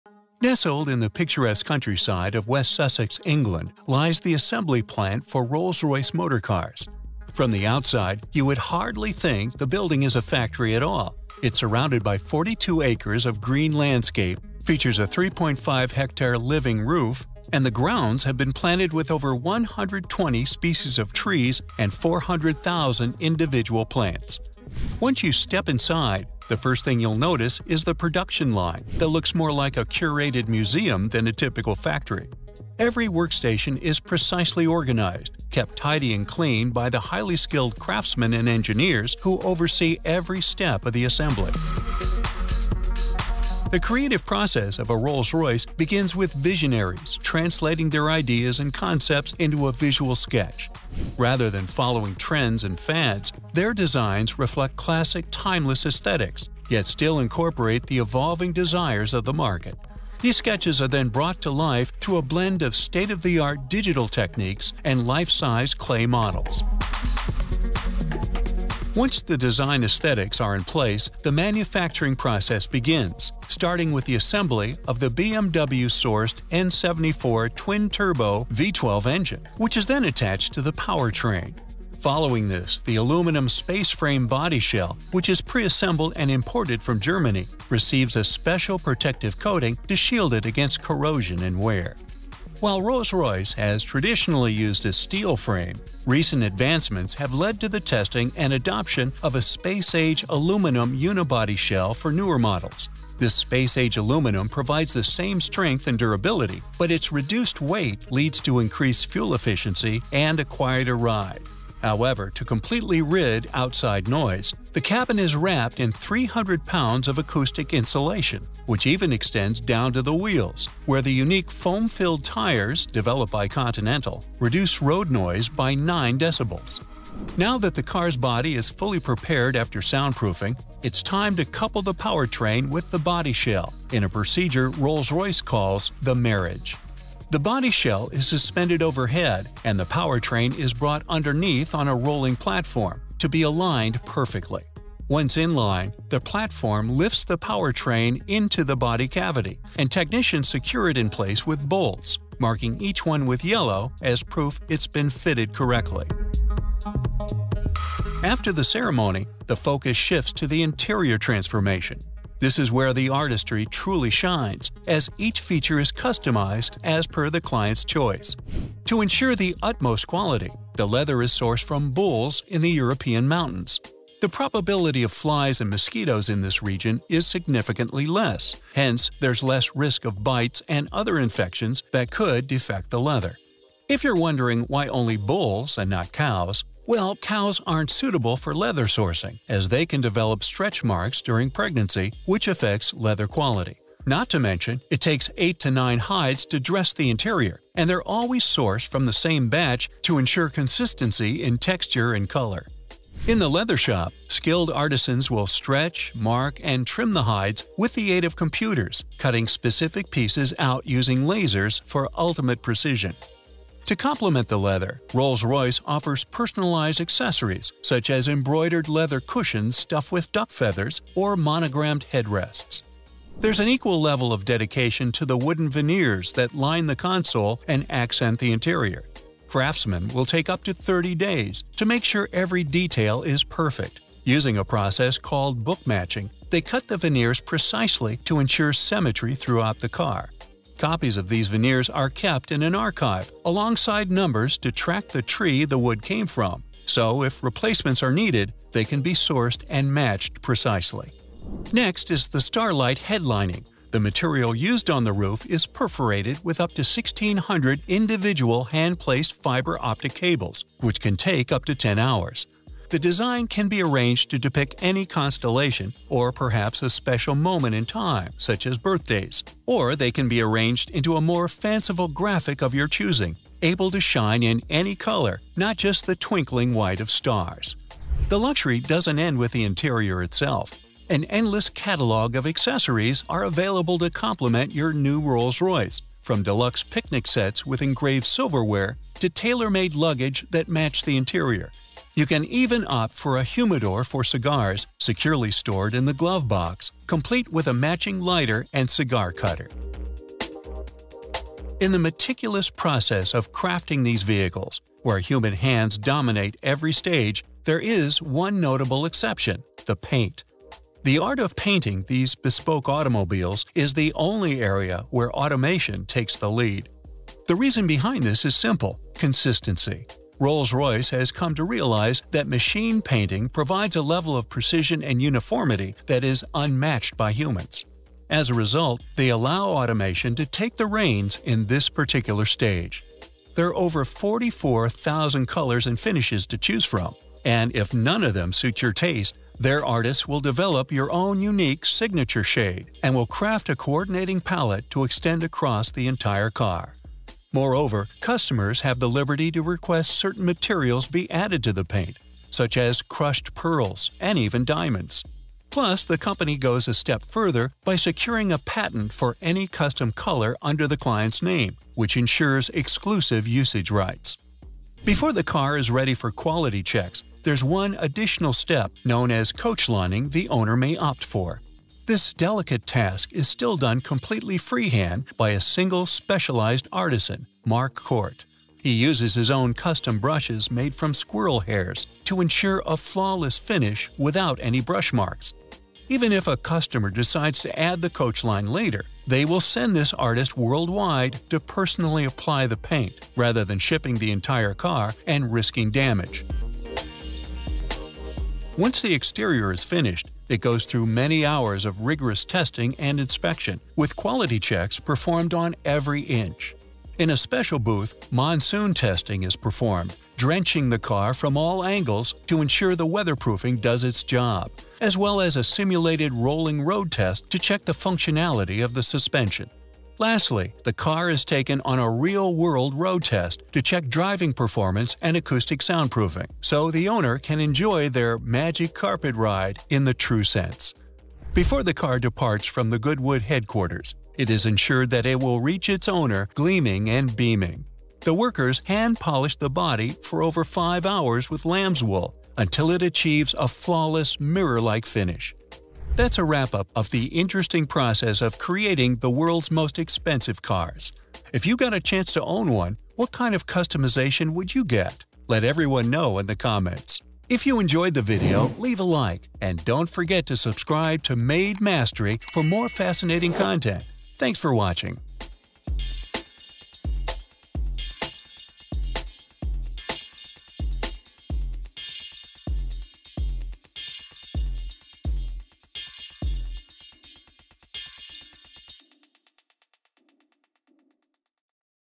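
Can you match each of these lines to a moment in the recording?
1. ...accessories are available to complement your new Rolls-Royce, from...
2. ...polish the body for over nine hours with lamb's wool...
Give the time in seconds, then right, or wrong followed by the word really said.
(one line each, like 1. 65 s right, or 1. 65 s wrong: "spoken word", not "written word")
1. 282 s right
2. 439 s wrong: "five", not "nine".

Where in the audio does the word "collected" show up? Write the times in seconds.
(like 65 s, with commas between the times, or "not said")
not said.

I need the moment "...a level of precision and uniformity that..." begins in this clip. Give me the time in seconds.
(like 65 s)
323 s.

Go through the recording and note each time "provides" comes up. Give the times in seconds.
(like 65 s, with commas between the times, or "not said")
104 s, 323 s.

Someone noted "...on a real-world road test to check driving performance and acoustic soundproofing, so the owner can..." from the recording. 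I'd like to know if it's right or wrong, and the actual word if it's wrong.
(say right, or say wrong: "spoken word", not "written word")
right.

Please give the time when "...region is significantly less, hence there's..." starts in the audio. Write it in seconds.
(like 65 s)
176 s.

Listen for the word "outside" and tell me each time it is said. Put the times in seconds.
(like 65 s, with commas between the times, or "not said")
7 s, 113 s.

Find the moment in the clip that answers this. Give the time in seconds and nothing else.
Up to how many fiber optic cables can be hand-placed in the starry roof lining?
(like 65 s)
256 s.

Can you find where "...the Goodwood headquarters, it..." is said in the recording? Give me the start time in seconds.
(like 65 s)
432 s.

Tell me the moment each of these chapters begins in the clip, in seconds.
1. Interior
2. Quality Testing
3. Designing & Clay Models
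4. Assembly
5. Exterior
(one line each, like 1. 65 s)
1. 157 s
2. 397 s
3. 42 s
4. 67 s
5. 300 s.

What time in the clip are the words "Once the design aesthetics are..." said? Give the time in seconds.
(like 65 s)
68 s.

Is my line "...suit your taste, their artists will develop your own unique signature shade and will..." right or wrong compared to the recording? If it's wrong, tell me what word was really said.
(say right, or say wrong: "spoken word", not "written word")
right.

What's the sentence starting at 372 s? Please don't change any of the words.
This delicate task is still done completely freehand by a single specialized artisan, Mark Court.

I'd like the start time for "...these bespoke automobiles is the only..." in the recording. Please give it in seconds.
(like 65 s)
312 s.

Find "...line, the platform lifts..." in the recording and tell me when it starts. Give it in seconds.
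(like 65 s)
145 s.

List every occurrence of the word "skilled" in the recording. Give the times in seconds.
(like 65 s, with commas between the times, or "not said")
37 s, 204 s.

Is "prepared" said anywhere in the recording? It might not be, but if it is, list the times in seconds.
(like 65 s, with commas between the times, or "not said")
128 s.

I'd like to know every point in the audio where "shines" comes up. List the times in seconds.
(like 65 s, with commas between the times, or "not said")
164 s, 274 s.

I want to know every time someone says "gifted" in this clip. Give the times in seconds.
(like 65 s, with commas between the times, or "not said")
not said.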